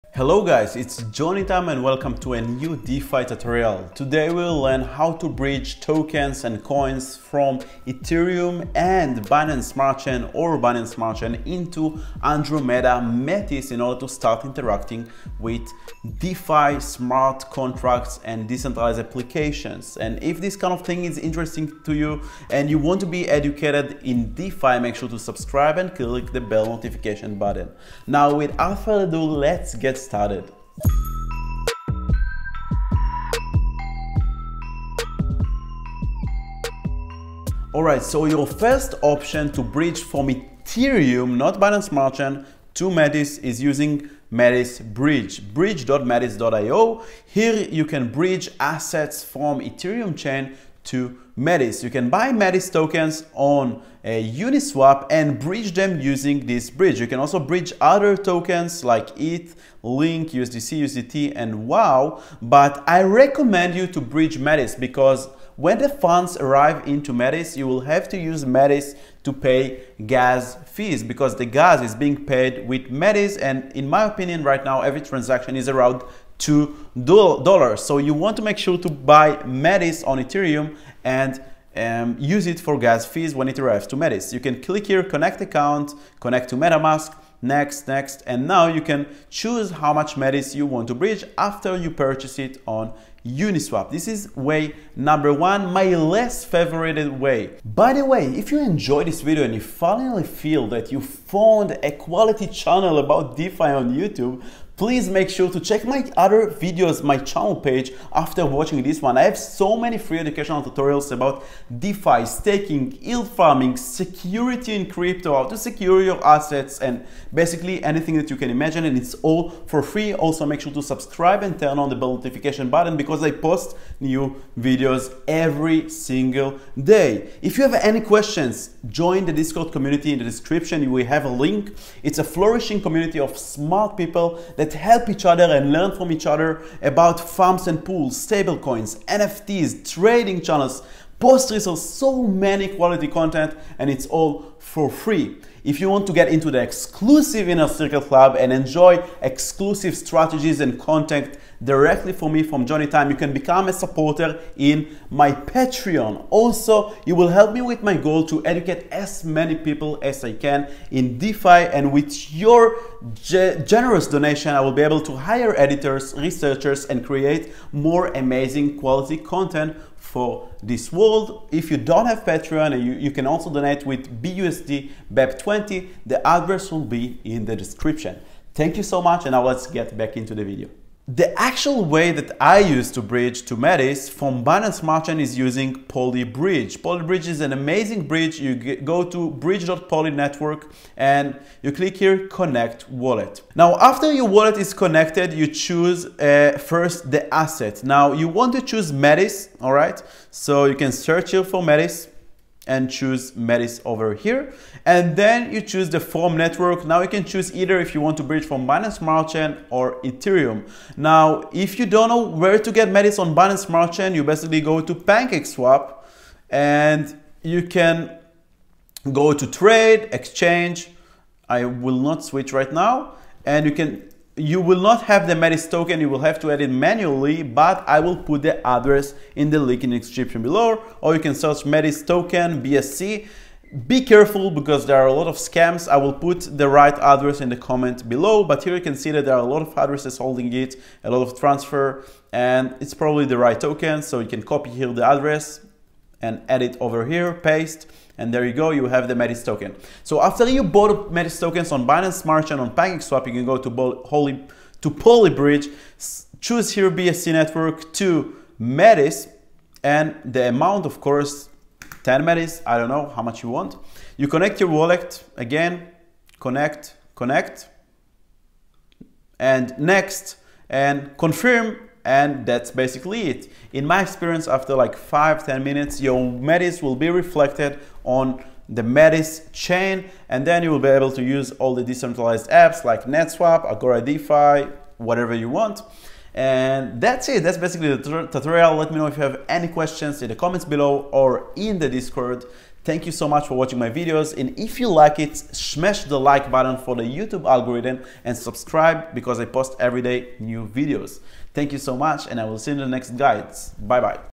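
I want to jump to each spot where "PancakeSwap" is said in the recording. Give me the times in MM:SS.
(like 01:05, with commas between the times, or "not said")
03:34, 04:12.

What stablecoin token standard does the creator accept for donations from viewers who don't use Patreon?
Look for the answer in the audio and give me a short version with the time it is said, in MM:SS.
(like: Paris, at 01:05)
BUSD BEP20, at 02:54.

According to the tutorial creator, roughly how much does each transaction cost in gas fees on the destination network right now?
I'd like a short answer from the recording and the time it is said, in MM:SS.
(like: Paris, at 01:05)
2 dollars, at 01:16.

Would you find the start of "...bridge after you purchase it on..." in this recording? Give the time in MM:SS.
01:30.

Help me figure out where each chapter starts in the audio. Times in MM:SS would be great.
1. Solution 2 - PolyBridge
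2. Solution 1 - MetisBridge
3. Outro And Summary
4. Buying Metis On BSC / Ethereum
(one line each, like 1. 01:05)
1. 03:00
2. 00:36
3. 04:45
4. 03:30.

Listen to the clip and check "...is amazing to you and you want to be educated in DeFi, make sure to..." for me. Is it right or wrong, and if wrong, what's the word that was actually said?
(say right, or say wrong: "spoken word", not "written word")
wrong: "interesting", not "amazing".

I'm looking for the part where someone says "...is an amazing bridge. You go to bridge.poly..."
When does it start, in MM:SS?
03:07.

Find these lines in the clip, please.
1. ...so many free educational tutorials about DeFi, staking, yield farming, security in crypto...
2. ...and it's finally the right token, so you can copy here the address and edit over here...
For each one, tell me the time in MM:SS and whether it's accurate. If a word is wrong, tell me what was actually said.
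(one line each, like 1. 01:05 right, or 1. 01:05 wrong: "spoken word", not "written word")
1. 01:49 right
2. 04:02 wrong: "probably", not "finally".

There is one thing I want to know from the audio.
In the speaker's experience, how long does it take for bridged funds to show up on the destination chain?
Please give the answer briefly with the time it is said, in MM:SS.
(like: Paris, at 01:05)
5 to 10 minutes, at 04:34.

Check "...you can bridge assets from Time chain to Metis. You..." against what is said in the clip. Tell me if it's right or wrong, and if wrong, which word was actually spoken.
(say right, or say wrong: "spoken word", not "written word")
wrong: "Ethereum", not "Time".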